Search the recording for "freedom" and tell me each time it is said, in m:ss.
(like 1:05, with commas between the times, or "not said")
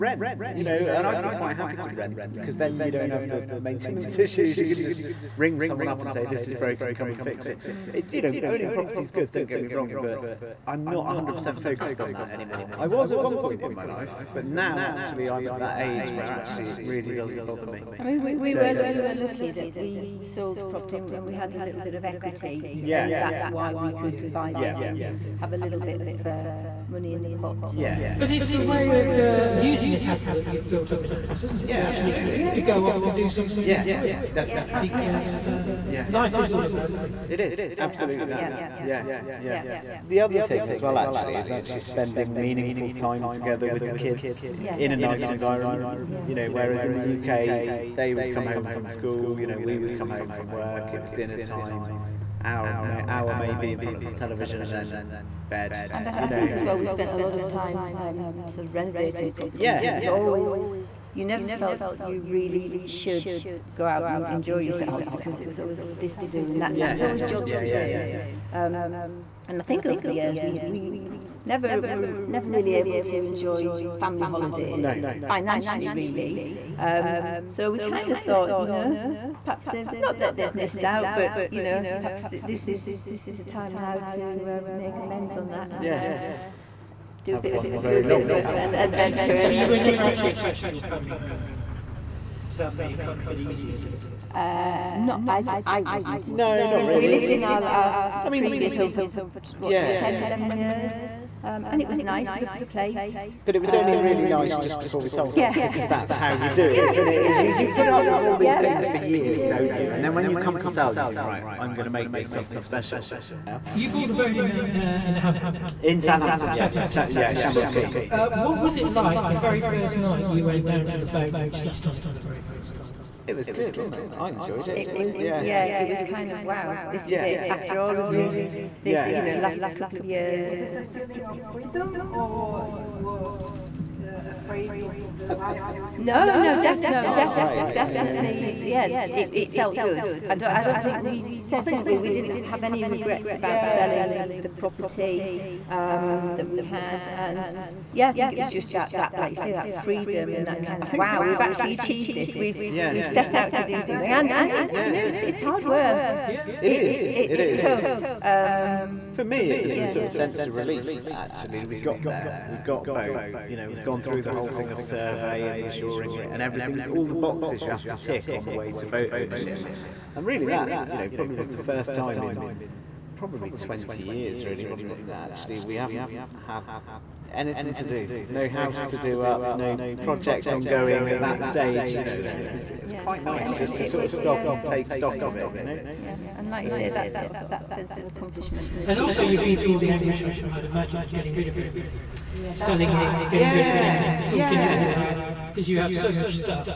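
2:11, 2:29.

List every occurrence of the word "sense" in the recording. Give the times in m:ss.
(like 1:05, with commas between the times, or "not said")
2:40, 3:07.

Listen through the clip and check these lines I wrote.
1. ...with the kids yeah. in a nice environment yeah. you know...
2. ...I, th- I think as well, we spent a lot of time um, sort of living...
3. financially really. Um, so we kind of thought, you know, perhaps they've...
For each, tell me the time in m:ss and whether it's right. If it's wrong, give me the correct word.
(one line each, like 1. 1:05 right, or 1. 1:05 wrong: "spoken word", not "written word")
1. 0:43 right
2. 0:56 wrong: "renovating", not "living"
3. 1:15 right.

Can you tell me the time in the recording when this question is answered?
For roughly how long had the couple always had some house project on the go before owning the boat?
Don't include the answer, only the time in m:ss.
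2:53.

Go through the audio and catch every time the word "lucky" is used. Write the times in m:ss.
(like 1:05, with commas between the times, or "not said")
0:19.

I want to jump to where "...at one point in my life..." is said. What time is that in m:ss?
0:13.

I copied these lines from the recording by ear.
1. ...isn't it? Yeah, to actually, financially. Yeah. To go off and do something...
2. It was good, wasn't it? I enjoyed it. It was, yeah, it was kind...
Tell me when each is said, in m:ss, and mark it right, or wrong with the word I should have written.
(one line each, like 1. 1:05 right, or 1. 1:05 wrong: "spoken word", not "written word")
1. 0:31 wrong: "absolutely", not "financially"
2. 2:03 right.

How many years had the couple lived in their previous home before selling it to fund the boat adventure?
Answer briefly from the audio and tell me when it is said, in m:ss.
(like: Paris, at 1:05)
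10 or 11 years, at 1:39.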